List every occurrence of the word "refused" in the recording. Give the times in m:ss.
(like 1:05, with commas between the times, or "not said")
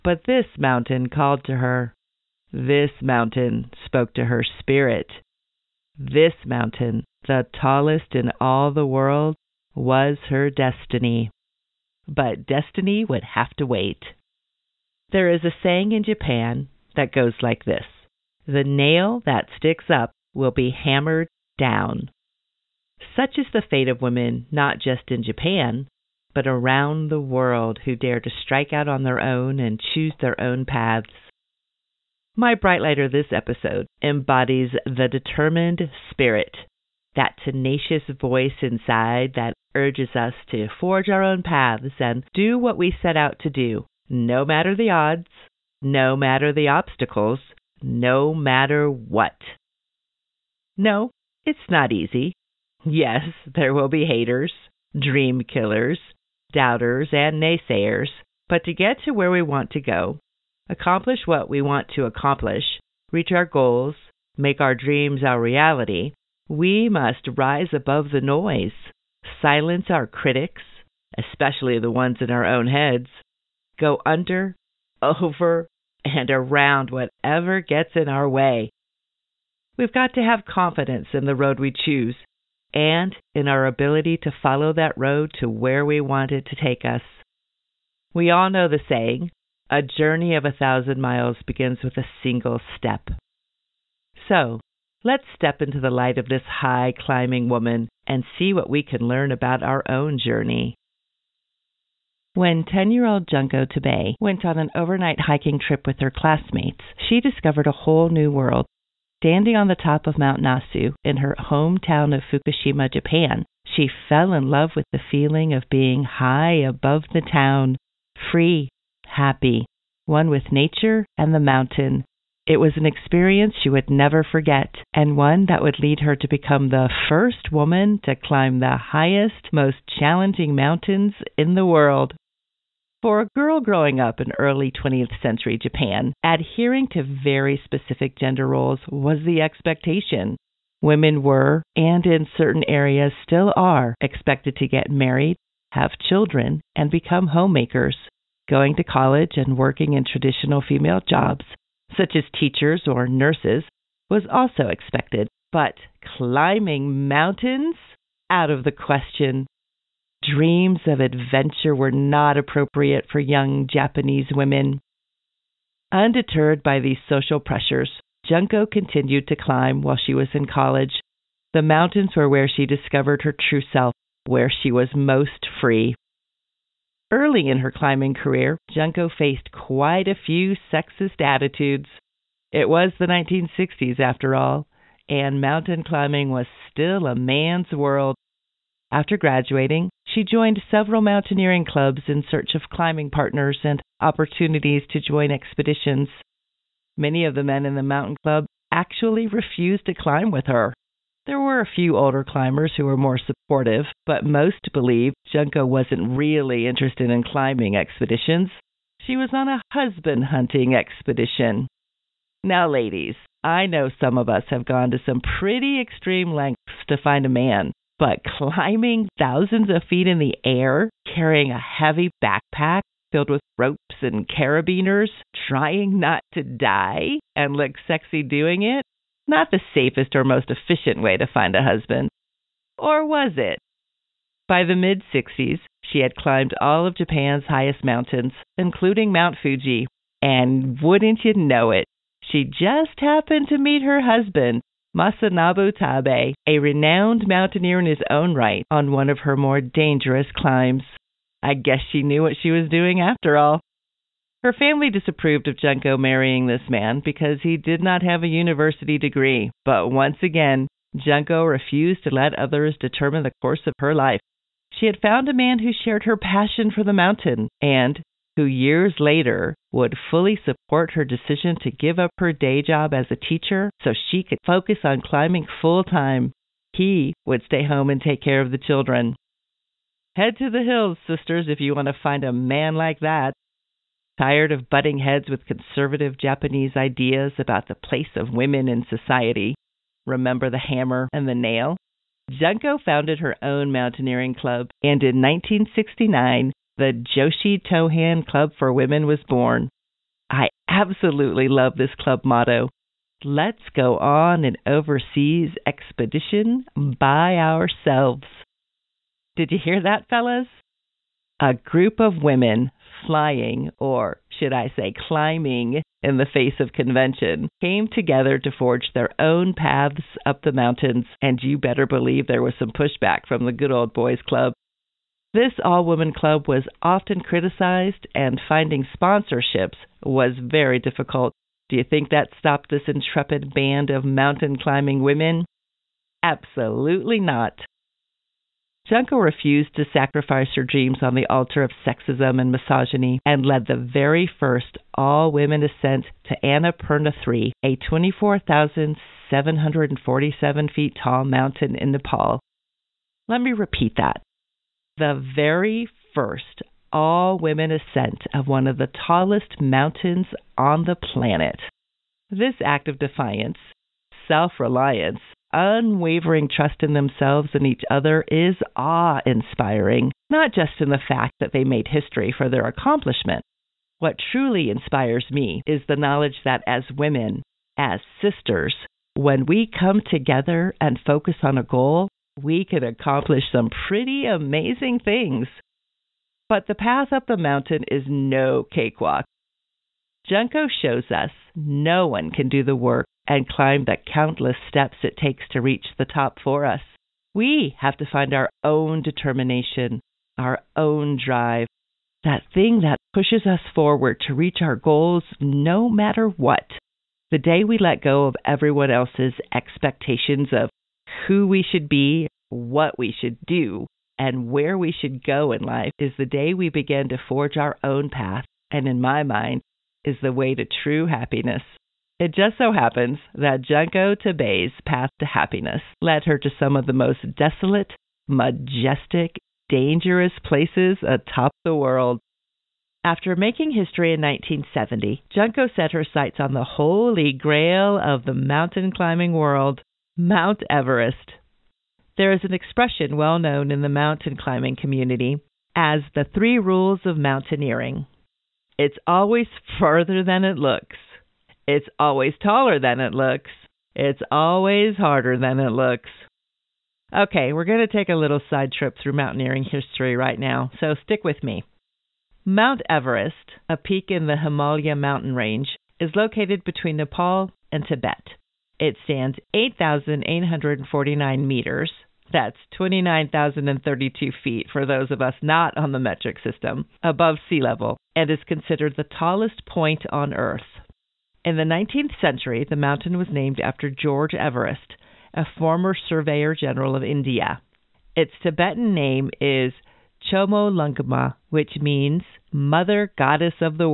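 3:19, 4:21, 5:39.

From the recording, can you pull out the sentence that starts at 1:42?
When 10 year old Junko Tabei went on an overnight hiking trip with her classmates, she discovered a whole new world.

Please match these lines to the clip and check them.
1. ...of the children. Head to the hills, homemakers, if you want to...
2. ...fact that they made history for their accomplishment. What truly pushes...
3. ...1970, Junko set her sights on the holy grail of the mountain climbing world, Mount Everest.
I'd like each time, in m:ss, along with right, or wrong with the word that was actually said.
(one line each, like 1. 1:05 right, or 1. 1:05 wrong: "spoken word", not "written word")
1. 4:38 wrong: "sisters", not "homemakers"
2. 6:11 wrong: "inspires", not "pushes"
3. 7:14 right.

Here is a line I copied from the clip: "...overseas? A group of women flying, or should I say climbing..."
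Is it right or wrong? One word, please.
wrong.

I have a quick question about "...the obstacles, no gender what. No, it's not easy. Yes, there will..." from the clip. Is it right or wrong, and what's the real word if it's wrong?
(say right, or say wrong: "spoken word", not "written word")
wrong: "matter", not "gender".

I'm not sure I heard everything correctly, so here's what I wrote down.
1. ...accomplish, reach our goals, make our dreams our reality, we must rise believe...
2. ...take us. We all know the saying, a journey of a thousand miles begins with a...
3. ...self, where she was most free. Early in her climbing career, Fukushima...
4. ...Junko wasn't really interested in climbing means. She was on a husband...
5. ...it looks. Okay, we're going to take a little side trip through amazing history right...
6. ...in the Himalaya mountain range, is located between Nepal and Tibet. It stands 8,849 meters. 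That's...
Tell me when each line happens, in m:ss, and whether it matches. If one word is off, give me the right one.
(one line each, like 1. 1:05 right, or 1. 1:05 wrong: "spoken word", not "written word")
1. 1:02 wrong: "above", not "believe"
2. 1:26 right
3. 2:53 wrong: "Junko", not "Fukushima"
4. 3:25 wrong: "expeditions", not "means"
5. 7:35 wrong: "mountaineering", not "amazing"
6. 7:44 right.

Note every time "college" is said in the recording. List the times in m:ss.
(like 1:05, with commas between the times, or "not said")
2:28, 2:50.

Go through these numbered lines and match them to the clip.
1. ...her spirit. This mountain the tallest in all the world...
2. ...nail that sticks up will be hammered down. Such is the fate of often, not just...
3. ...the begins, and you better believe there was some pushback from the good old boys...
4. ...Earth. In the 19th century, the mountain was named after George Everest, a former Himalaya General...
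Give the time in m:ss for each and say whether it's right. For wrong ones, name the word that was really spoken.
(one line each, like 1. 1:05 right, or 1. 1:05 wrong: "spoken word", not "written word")
1. 0:04 right
2. 0:18 wrong: "women", not "often"
3. 5:20 wrong: "mountains", not "begins"
4. 8:00 wrong: "Surveyor", not "Himalaya".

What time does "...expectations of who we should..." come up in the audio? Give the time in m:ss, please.
6:49.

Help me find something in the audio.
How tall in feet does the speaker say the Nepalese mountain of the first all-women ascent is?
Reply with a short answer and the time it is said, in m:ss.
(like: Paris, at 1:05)
24,747 feet, at 5:47.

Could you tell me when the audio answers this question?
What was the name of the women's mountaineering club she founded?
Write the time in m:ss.
4:57.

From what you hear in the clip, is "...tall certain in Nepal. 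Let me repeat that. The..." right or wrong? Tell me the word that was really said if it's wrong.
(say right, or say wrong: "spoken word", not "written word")
wrong: "mountain", not "certain".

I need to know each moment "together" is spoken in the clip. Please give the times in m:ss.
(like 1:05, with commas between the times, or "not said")
5:17, 6:20.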